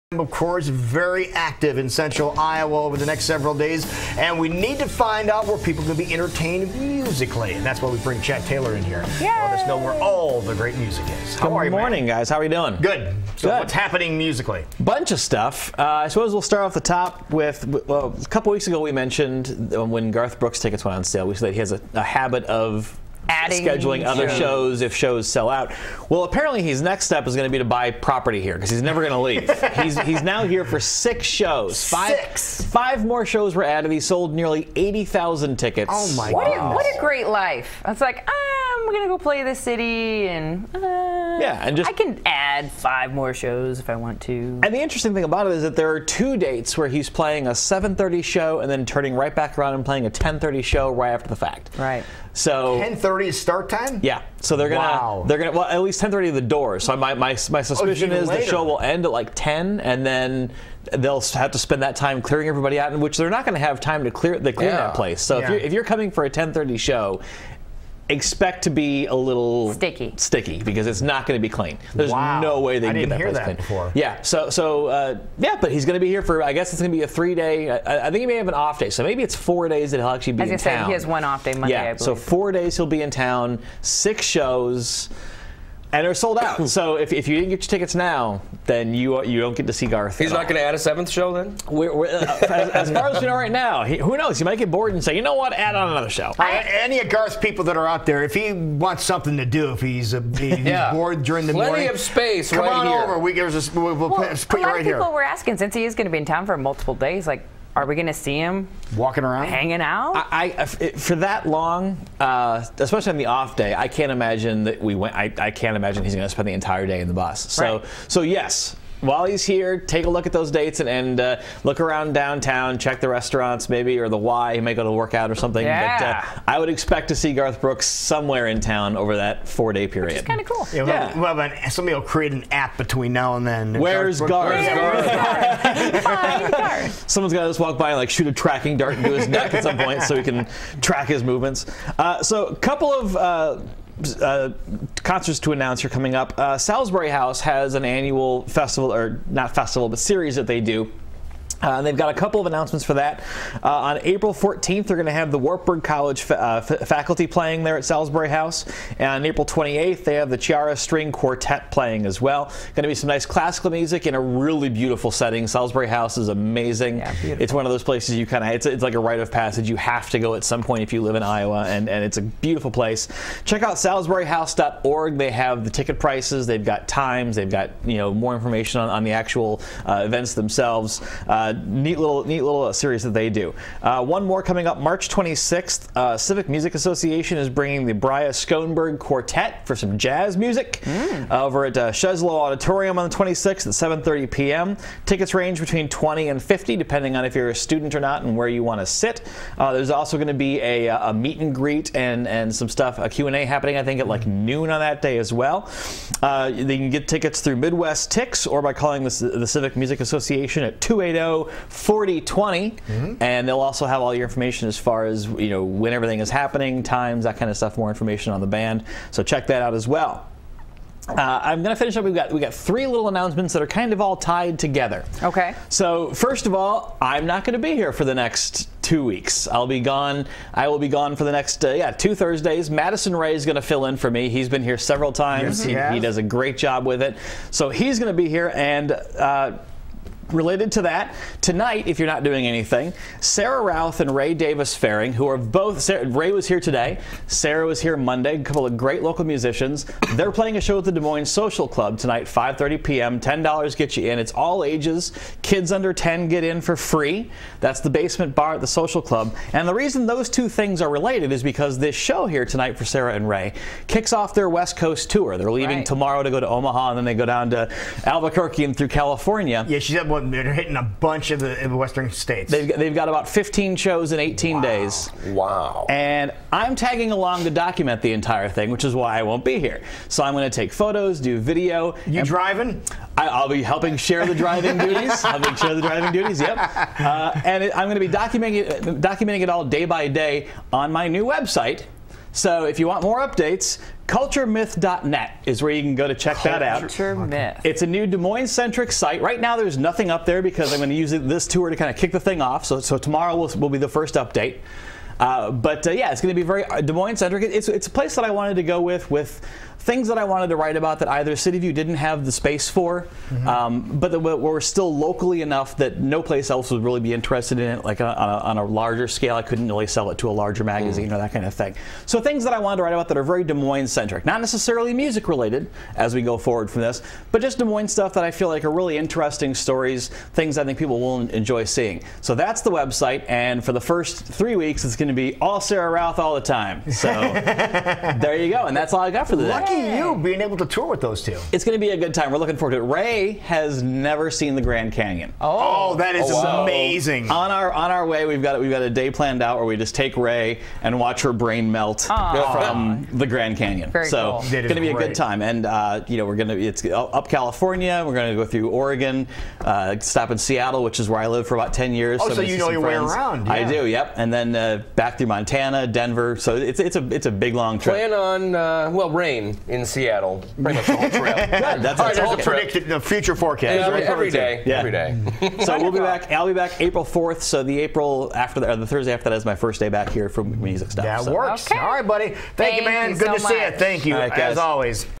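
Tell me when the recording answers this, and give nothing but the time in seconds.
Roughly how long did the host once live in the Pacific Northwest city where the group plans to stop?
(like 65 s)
361 s.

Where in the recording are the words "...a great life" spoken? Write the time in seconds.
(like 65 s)
36 s.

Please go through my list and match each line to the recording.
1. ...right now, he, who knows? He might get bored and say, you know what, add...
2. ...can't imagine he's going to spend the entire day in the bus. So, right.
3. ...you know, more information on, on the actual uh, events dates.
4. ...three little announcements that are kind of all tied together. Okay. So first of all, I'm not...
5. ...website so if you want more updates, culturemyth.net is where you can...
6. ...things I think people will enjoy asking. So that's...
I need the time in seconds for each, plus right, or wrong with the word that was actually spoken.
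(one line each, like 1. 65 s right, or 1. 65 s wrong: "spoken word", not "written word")
1. 93 s right
2. 115 s right
3. 177 s wrong: "themselves", not "dates"
4. 222 s right
5. 291 s right
6. 330 s wrong: "seeing", not "asking".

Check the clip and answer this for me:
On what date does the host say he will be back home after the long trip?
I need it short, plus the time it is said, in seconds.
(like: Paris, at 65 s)
April 4, at 376 s.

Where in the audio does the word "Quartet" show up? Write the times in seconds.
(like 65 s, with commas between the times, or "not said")
161 s, 188 s.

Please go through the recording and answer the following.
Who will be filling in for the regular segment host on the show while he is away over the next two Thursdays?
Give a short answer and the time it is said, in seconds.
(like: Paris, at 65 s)
Madison Ray, at 232 s.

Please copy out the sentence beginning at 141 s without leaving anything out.
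Uh, so, a couple of uh, uh, concerts to announce are coming up.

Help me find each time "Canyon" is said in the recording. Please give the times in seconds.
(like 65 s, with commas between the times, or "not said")
344 s, 353 s.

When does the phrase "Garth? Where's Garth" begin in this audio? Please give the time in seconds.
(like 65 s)
134 s.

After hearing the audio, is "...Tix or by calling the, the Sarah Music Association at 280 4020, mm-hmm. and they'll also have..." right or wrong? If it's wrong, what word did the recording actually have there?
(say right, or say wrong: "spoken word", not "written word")
wrong: "Civic", not "Sarah".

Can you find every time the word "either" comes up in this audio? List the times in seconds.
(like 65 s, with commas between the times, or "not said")
311 s.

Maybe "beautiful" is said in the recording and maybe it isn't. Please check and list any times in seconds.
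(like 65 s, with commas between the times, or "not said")
164 s, 172 s.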